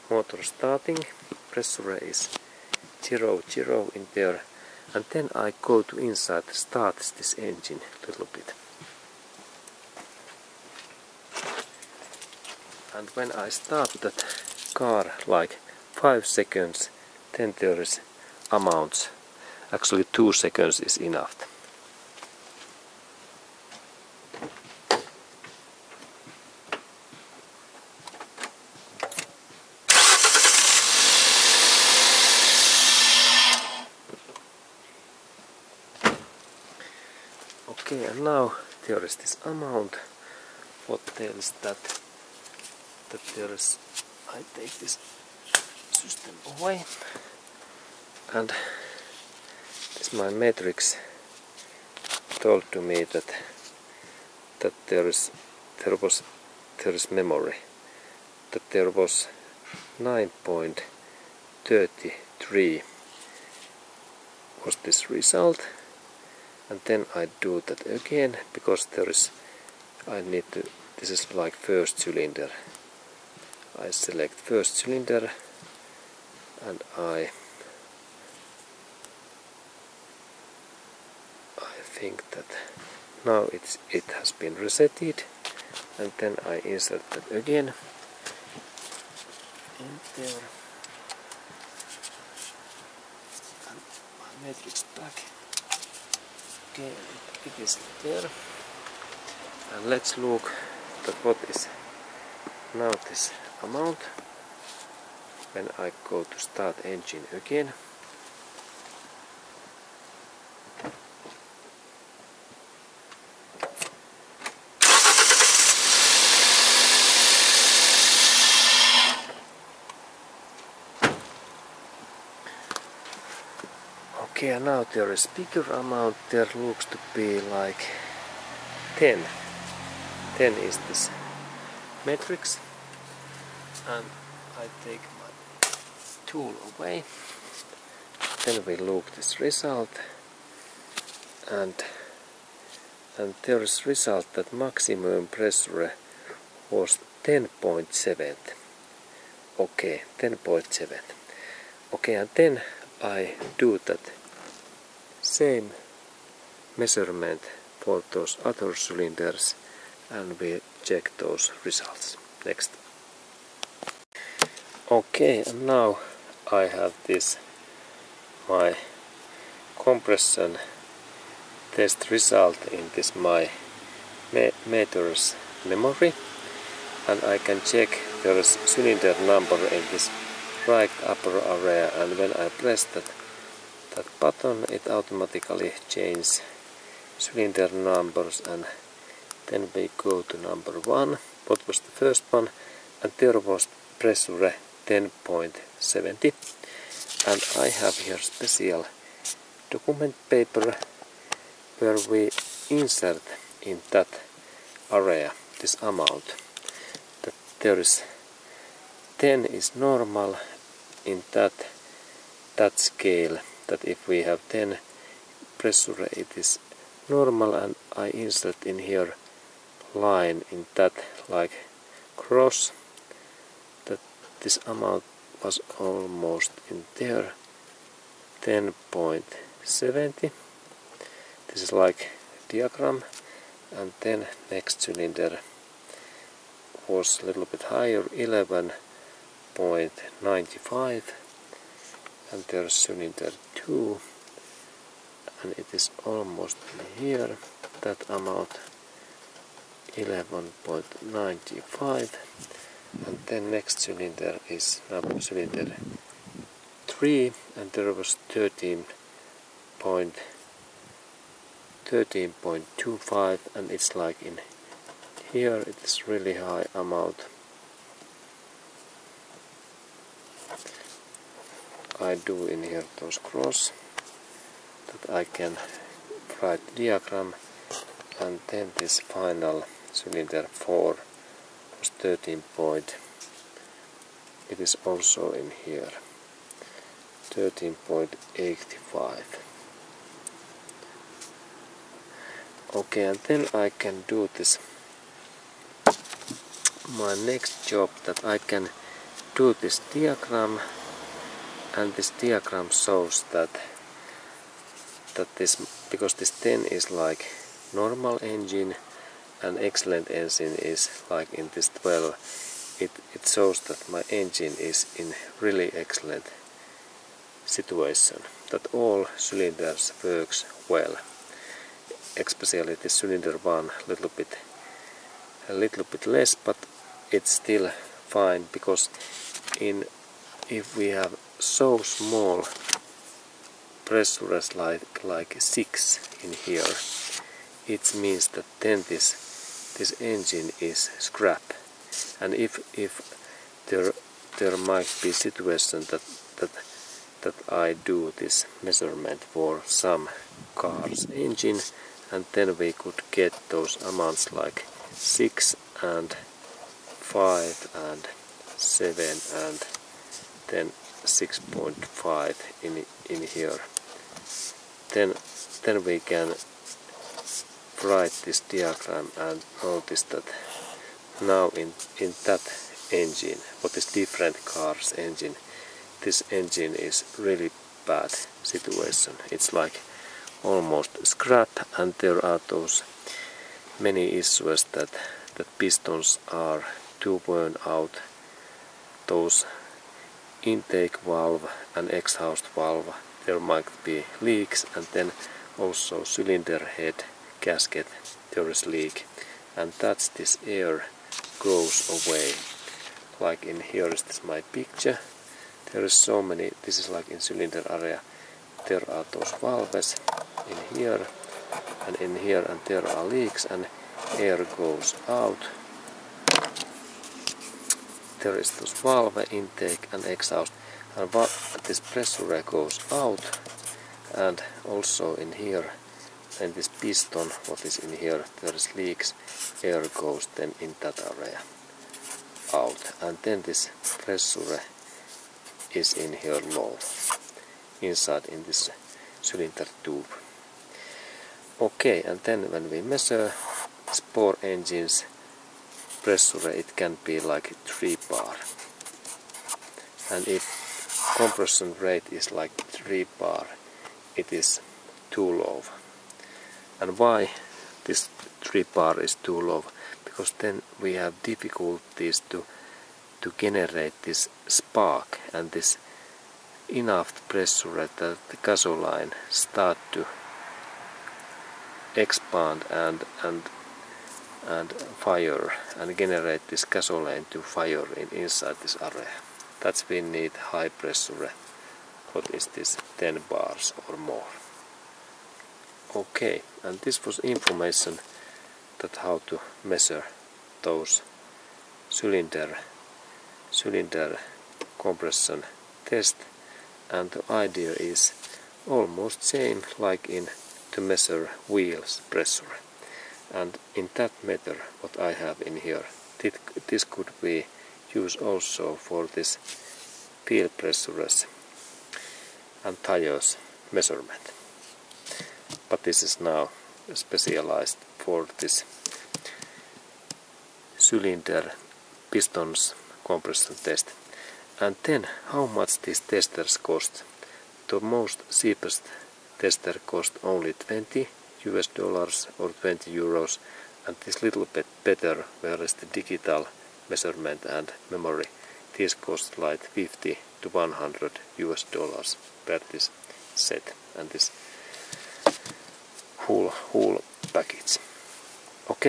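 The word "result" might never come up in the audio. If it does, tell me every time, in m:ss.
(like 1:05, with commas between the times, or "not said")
1:05, 2:19, 2:23, 2:41, 2:52.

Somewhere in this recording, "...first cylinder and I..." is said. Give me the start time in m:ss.
1:14.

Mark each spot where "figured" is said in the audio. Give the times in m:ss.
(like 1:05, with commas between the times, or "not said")
not said.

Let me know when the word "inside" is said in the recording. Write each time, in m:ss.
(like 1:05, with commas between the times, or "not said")
0:05, 7:17, 7:58.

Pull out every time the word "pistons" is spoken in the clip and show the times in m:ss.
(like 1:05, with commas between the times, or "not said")
6:25, 7:06, 8:42.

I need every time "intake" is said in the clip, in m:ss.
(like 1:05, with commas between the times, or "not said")
6:30, 6:59.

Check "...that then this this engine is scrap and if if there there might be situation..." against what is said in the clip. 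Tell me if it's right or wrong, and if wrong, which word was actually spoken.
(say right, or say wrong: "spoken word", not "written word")
right.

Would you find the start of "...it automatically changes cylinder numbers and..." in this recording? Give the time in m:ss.
3:04.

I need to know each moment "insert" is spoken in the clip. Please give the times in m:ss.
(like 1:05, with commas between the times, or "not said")
1:26, 3:22, 3:38.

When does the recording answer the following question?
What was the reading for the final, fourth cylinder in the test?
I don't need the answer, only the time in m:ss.
4:47.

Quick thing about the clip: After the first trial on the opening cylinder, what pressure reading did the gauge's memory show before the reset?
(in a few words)
9.33.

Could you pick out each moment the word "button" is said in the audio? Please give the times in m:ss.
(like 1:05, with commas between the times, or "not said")
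3:04.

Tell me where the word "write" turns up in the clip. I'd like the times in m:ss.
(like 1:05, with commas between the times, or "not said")
4:36, 6:07.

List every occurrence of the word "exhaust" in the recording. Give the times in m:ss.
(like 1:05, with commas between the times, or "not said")
6:31, 7:00.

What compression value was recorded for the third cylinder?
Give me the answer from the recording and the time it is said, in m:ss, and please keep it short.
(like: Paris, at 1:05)
13.25, at 4:21.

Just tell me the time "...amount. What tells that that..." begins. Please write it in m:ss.
0:39.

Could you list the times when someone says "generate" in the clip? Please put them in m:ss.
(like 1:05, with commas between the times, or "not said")
7:43, 7:55.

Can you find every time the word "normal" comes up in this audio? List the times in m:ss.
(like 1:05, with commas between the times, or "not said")
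3:29, 3:37, 5:07.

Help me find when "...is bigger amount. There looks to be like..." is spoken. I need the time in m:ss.
2:05.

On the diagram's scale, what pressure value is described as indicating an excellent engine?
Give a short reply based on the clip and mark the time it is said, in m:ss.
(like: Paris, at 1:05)
12, at 5:11.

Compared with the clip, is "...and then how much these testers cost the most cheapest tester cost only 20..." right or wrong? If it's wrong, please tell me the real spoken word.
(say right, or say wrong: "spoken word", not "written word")
right.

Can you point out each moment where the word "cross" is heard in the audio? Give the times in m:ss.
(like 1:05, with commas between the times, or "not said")
3:42, 4:33.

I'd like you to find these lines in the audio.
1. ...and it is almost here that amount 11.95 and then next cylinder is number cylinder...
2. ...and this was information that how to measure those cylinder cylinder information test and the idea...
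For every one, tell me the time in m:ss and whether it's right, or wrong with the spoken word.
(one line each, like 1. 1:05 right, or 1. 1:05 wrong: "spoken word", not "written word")
1. 4:05 right
2. 8:06 wrong: "compression", not "information".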